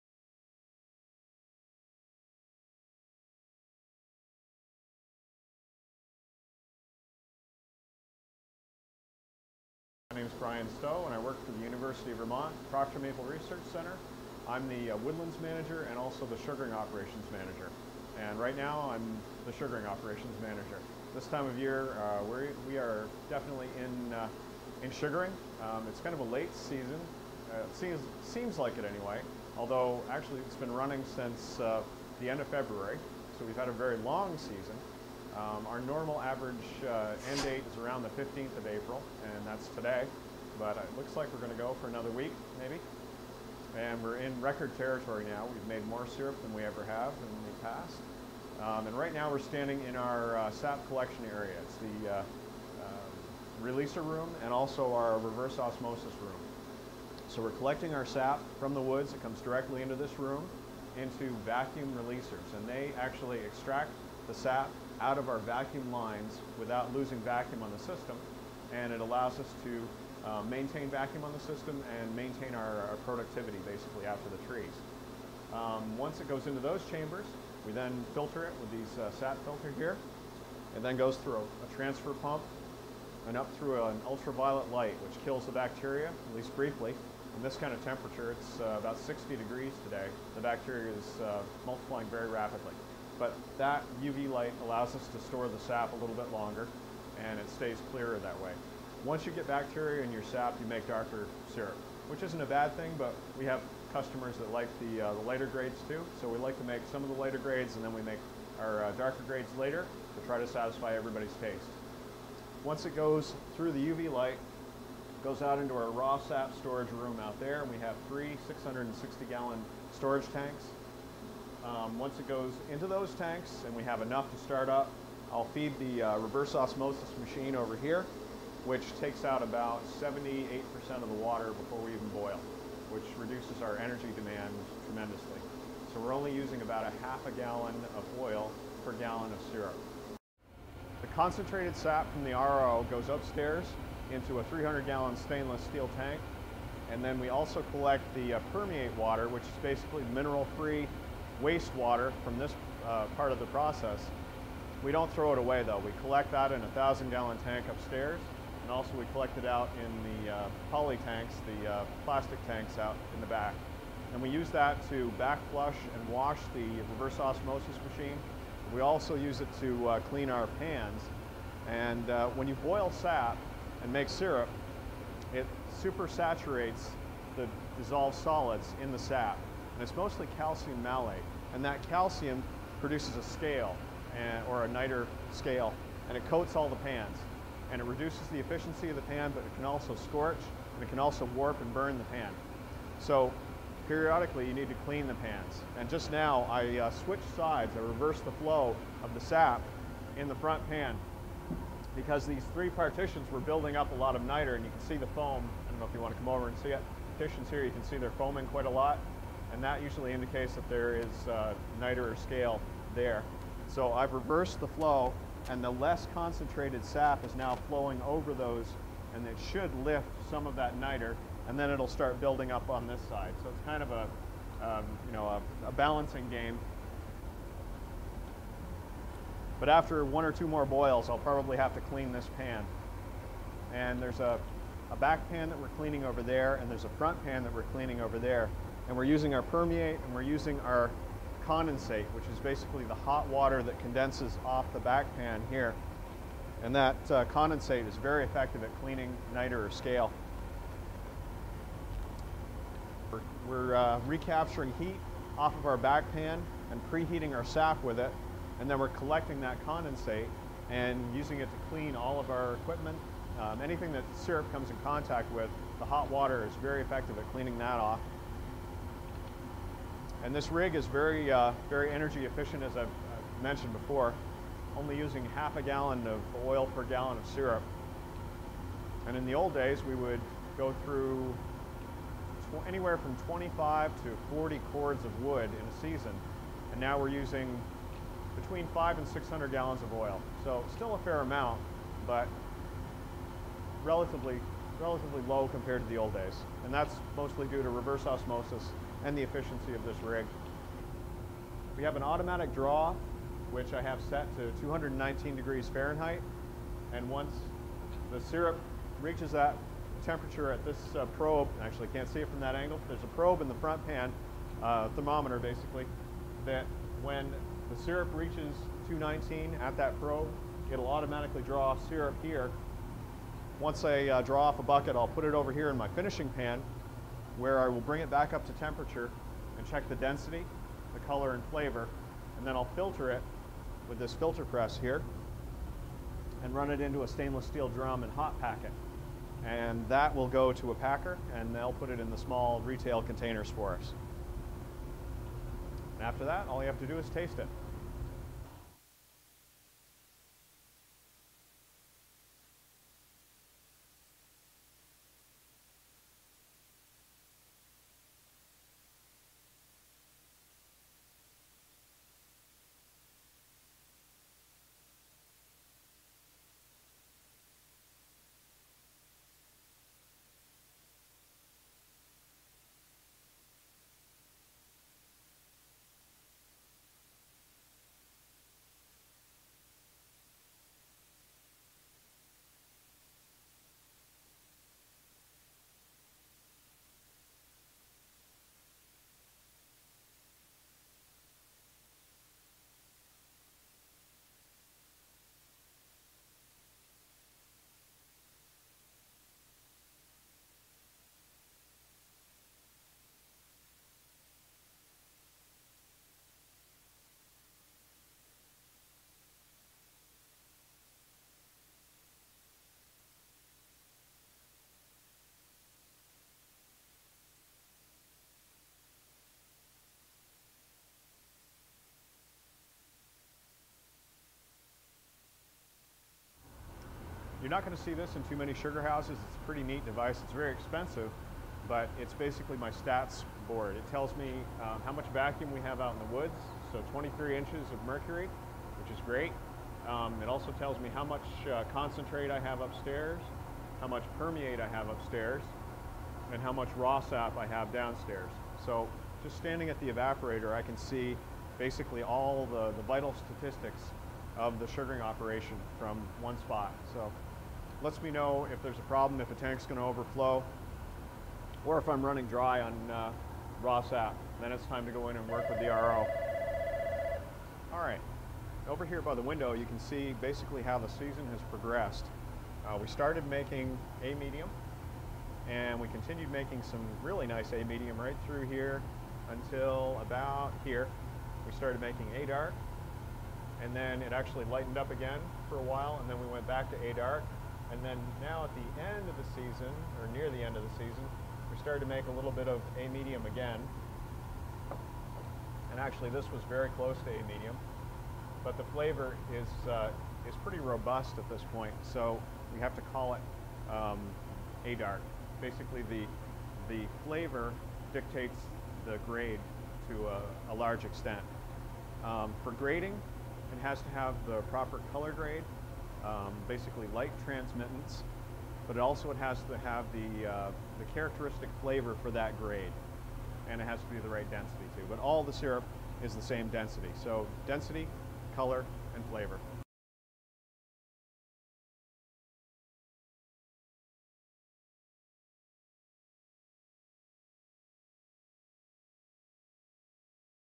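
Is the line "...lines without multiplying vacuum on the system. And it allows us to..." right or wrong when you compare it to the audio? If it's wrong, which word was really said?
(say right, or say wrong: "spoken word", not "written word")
wrong: "losing", not "multiplying".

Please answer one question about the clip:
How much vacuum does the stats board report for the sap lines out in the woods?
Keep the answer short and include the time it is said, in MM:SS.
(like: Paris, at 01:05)
23 inches of mercury, at 07:16.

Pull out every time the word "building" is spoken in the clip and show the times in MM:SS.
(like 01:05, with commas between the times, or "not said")
03:23, 03:42.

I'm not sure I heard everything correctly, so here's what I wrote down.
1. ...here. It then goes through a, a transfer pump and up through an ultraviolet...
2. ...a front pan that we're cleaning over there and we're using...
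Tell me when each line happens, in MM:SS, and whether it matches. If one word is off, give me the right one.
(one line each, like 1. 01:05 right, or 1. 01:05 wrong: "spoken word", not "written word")
1. 01:19 right
2. 03:56 right.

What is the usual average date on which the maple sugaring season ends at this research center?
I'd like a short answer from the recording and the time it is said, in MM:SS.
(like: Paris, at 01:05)
April 15, at 00:38.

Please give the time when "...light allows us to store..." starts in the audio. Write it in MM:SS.
01:34.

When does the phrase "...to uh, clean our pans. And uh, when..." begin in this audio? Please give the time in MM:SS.
02:49.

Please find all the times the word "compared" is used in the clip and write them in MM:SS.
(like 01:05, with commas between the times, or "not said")
04:55.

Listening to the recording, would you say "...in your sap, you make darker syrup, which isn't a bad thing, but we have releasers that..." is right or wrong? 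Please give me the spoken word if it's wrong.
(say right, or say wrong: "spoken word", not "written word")
wrong: "customers", not "releasers".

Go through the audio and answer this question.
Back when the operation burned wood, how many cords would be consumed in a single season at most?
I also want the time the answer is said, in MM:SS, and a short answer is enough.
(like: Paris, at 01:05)
40 cords, at 04:44.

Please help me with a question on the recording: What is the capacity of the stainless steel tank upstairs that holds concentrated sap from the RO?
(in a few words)
300 gallons.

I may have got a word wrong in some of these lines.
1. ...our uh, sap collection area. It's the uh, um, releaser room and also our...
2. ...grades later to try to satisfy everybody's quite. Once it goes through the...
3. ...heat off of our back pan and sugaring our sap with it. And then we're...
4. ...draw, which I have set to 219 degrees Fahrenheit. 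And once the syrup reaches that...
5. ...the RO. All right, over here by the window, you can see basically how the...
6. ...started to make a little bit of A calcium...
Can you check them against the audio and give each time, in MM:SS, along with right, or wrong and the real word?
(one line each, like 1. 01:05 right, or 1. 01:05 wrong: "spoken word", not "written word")
1. 00:49 right
2. 01:49 wrong: "taste", not "quite"
3. 04:14 wrong: "preheating", not "sugaring"
4. 05:02 right
5. 07:45 right
6. 08:11 wrong: "medium", not "calcium".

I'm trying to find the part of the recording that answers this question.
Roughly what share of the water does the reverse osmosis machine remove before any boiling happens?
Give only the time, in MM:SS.
02:09.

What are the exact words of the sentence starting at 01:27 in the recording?
In this kind of temperature, it's uh, about 60 degrees today.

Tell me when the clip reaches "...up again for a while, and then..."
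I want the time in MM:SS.
08:04.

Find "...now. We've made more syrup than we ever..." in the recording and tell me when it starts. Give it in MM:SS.
00:45.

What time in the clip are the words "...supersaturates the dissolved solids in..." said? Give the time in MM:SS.
02:55.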